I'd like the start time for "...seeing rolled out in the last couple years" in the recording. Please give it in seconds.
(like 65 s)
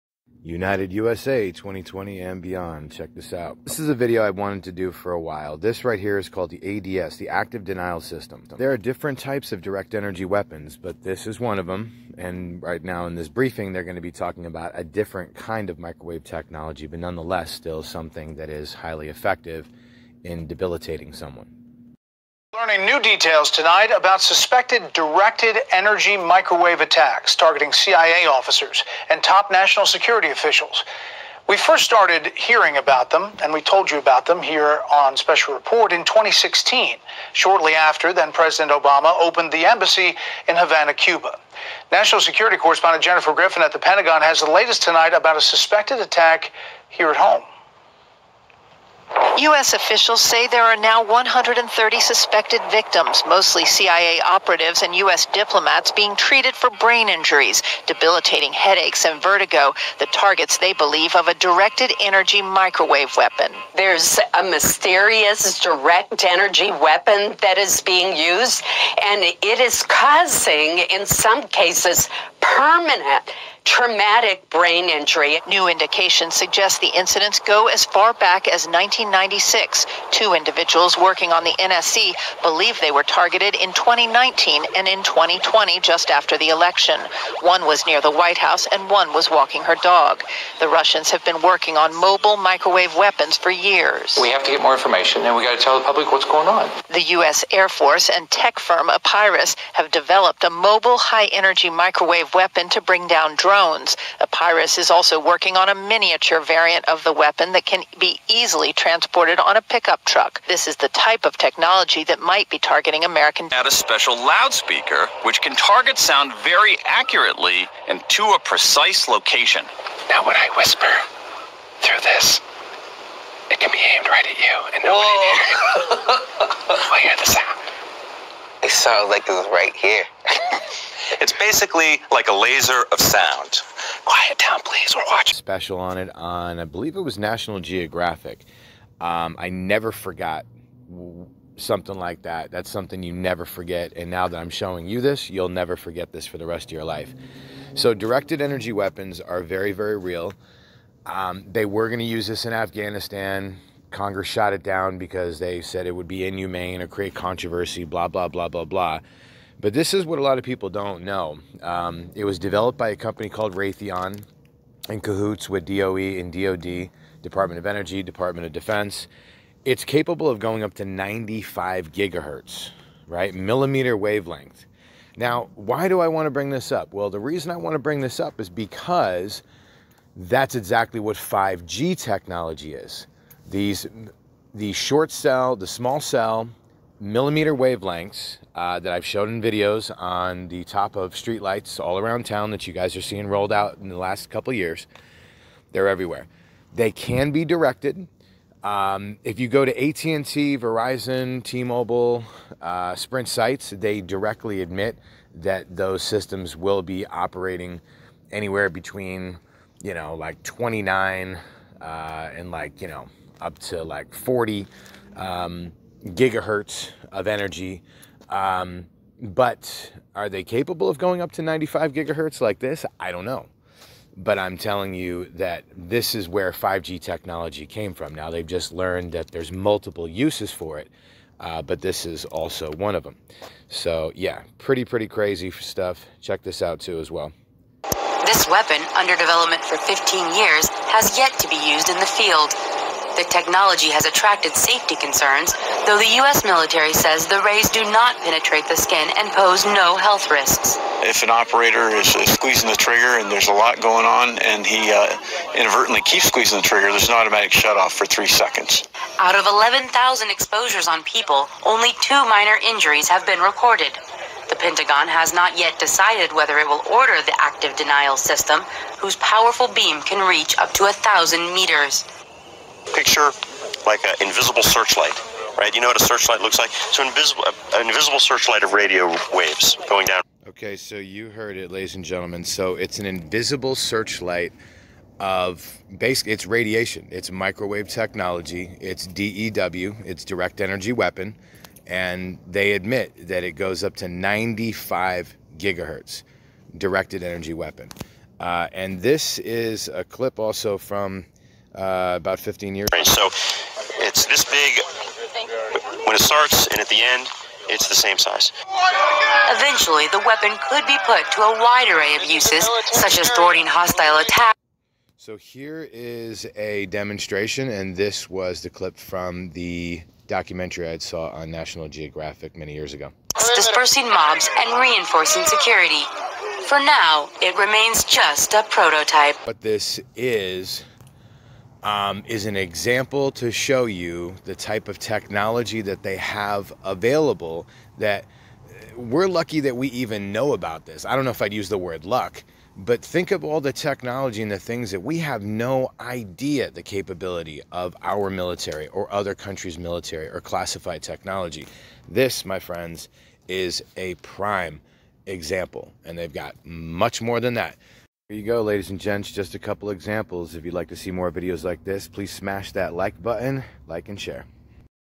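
193 s.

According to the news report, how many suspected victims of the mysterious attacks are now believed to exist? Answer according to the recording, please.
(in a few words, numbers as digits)
130.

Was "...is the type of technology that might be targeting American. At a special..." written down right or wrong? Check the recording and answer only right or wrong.
right.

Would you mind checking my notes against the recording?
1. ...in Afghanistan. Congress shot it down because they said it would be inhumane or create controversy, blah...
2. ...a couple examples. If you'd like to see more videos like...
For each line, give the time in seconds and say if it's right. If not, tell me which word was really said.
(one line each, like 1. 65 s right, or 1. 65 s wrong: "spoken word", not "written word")
1. 152 s right
2. 359 s right.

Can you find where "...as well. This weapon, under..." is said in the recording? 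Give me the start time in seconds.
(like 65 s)
236 s.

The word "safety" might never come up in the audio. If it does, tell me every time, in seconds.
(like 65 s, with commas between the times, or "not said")
244 s.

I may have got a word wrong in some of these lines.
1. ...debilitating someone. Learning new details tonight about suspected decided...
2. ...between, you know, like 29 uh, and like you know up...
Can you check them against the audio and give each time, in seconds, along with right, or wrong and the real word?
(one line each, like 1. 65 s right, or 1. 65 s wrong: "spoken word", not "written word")
1. 20 s wrong: "directed", not "decided"
2. 208 s right.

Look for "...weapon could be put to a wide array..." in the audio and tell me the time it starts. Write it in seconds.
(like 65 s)
310 s.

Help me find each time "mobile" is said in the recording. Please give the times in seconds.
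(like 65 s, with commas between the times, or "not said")
91 s, 100 s, 201 s.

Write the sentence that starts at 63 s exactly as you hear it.
There's a mysterious direct energy weapon that is being used, and it is causing, in some cases, permanent traumatic brain injury.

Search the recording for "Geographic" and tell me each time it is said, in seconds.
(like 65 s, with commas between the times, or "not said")
137 s, 321 s.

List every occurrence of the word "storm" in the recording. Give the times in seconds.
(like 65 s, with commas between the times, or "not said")
not said.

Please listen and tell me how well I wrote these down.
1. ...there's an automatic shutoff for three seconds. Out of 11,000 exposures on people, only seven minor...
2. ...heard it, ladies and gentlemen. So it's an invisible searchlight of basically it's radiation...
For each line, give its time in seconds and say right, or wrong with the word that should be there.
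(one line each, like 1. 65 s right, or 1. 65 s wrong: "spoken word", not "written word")
1. 256 s wrong: "two", not "seven"
2. 281 s right.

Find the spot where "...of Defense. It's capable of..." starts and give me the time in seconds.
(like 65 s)
168 s.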